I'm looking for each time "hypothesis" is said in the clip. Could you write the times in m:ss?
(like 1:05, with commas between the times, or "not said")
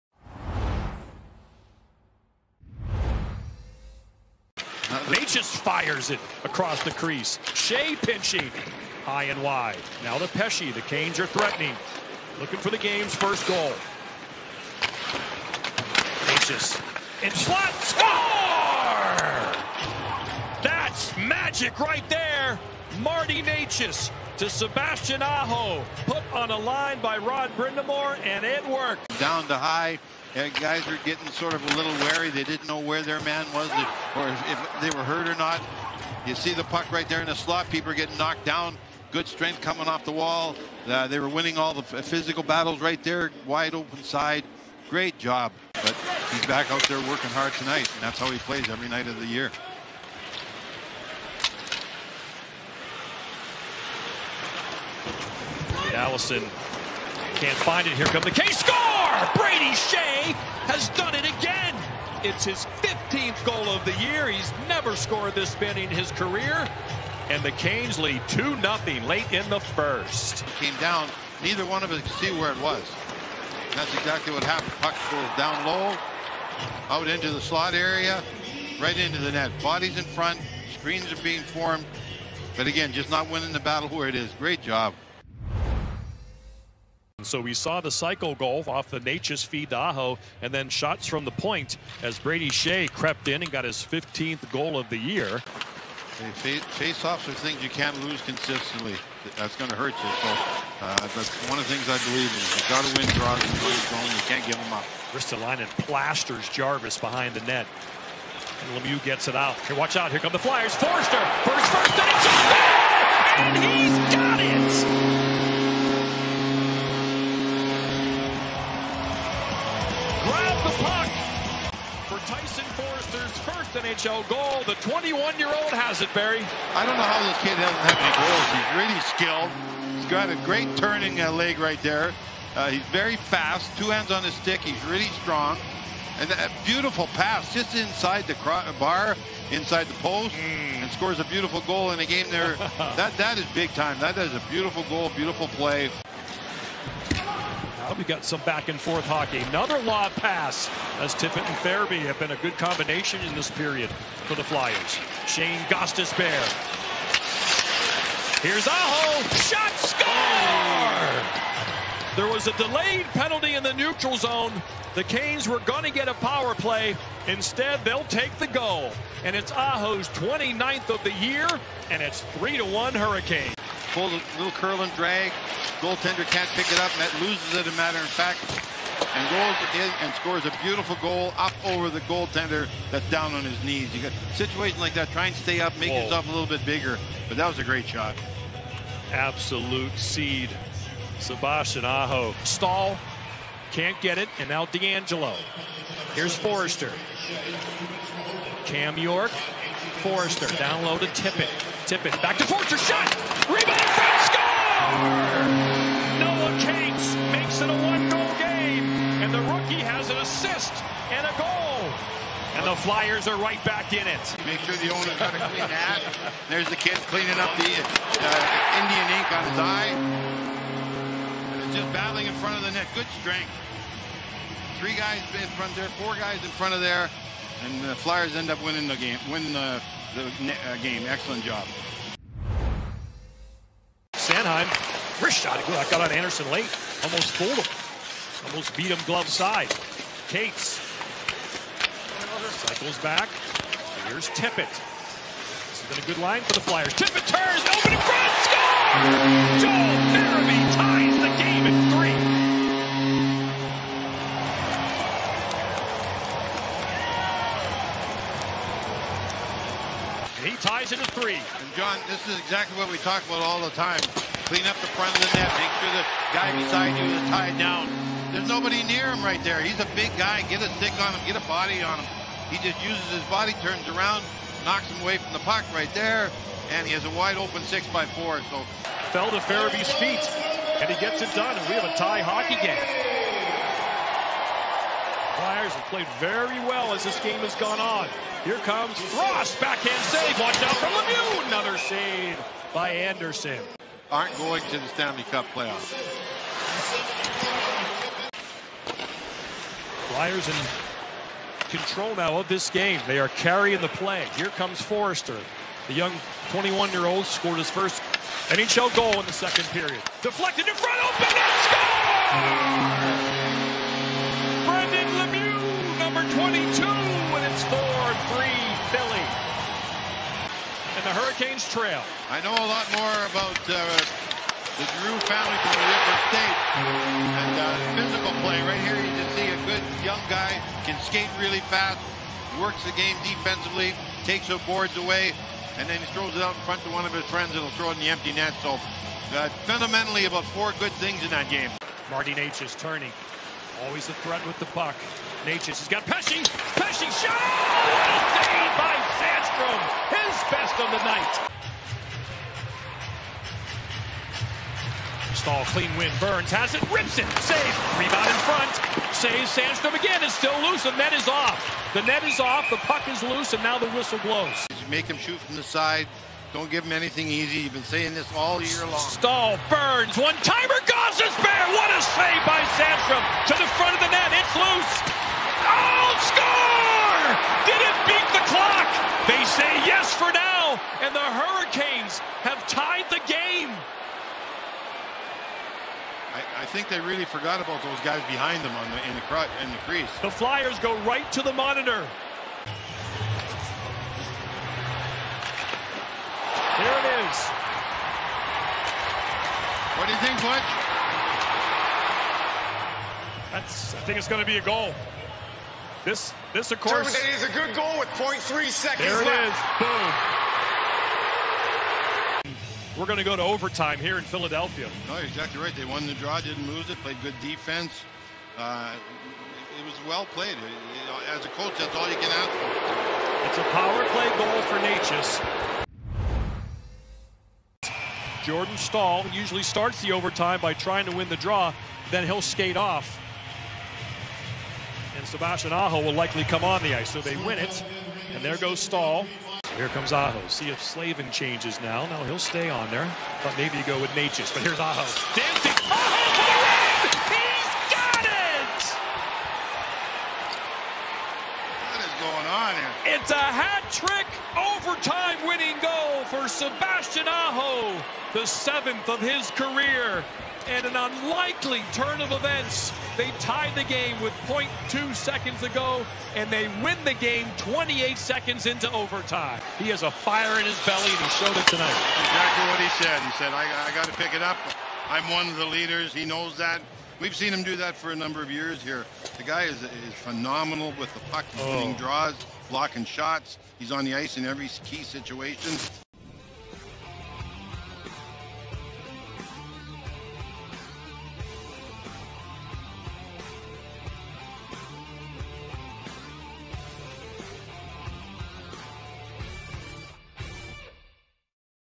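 not said.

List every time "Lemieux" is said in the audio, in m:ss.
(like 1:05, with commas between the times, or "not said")
1:48, 4:50, 5:15.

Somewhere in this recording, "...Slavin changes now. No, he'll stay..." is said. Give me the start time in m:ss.
7:20.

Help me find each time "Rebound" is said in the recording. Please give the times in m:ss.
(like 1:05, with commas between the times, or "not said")
3:23, 5:57.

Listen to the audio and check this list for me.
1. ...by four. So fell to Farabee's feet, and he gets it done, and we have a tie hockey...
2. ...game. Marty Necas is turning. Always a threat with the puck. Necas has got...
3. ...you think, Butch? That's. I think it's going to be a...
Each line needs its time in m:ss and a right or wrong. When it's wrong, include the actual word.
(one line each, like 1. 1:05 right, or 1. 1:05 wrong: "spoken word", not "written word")
1. 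4:37 right
2. 5:41 right
3. 6:40 right.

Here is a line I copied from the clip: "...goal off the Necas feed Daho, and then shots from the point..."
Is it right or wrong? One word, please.
right.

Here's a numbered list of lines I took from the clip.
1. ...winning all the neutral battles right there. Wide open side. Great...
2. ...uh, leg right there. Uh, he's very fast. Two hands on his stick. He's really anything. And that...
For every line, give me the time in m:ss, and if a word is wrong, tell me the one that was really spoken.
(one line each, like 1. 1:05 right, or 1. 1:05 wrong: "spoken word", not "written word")
1. 0:41 wrong: "physical", not "neutral"
2. 2:11 wrong: "strong", not "anything".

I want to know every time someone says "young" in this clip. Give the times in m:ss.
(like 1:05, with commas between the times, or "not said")
5:05, 5:30.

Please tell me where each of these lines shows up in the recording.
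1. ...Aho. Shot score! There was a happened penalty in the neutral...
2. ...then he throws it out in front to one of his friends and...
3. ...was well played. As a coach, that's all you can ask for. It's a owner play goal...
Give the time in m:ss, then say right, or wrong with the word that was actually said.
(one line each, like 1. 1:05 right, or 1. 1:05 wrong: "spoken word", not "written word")
1. 2:38 wrong: "delayed", not "happened"
2. 5:35 right
3. 6:59 wrong: "power", not "owner".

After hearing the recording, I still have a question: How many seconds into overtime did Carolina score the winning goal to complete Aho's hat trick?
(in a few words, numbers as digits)
28.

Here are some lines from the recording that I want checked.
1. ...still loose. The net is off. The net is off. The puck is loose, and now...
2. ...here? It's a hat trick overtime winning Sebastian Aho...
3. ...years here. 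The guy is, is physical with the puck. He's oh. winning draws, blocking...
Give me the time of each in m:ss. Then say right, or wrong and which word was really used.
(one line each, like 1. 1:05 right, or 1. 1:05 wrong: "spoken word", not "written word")
1. 6:00 right
2. 7:32 right
3. 7:58 wrong: "phenomenal", not "physical".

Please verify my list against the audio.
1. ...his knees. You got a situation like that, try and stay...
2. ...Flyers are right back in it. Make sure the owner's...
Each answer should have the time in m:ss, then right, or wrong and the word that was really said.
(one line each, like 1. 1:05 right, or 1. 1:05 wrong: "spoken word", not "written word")
1. 3:03 right
2. 3:32 right.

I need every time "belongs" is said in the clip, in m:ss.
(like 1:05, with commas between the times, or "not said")
not said.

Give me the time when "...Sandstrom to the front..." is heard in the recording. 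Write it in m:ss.
6:12.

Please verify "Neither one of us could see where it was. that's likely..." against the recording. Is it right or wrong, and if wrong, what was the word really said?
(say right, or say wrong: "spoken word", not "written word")
wrong: "exactly", not "likely".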